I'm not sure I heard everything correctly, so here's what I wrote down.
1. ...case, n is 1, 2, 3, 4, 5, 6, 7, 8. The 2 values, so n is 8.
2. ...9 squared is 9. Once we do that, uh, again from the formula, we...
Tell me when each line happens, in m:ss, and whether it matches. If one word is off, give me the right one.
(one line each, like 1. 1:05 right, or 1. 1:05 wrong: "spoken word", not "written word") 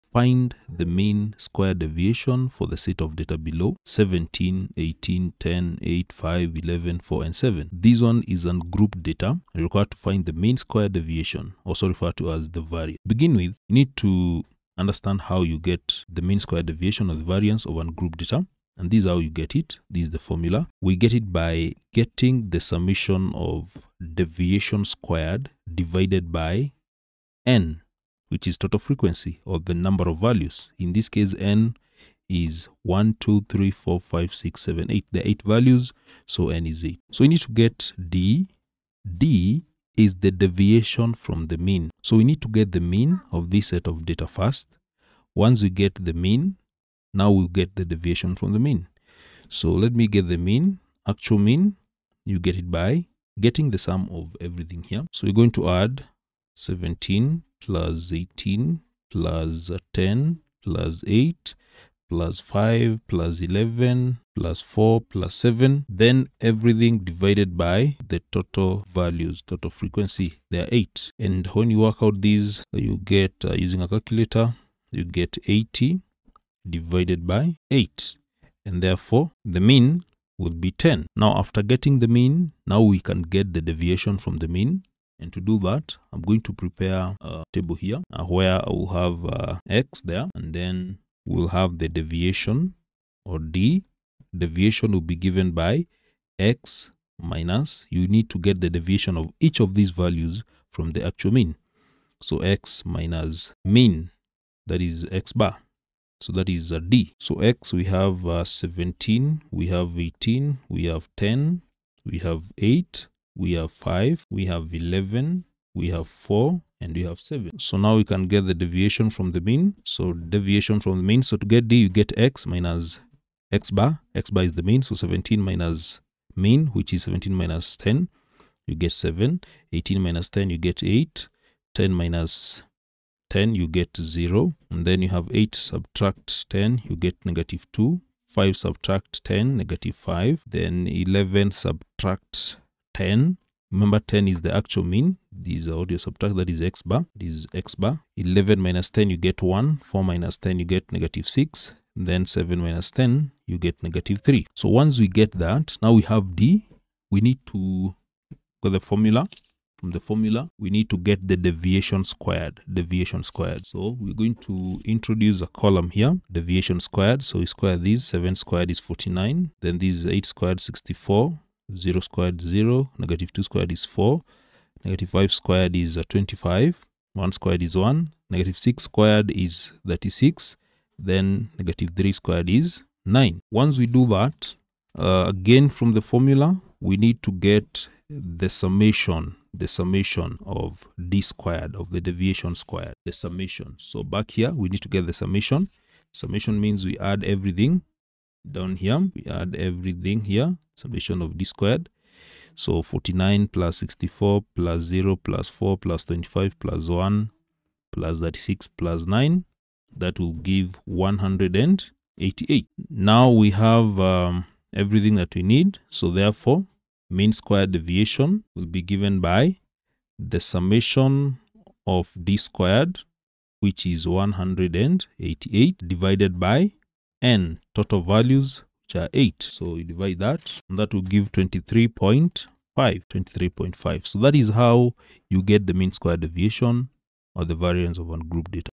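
1. 0:31 wrong: "8", not "2"
2. 3:01 wrong: "3", not "9".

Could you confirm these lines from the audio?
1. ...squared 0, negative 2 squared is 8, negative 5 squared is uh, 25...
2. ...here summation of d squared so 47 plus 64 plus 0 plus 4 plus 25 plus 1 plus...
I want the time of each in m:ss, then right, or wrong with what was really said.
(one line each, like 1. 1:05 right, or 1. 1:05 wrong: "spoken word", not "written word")
1. 2:52 wrong: "4", not "8"
2. 3:20 wrong: "49", not "47".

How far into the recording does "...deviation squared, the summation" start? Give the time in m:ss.
3:12.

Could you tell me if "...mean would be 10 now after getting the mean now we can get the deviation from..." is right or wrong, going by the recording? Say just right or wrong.
right.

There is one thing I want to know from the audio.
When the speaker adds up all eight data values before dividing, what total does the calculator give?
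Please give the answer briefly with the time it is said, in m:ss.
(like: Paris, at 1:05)
80, at 1:15.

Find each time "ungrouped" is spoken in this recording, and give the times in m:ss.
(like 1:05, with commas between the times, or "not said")
0:08, 0:17, 3:58.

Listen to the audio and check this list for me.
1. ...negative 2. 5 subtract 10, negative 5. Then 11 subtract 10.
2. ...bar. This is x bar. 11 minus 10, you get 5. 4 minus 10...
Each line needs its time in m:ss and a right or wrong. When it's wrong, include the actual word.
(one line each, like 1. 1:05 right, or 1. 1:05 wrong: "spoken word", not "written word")
1. 2:17 right
2. 2:26 wrong: "1", not "5".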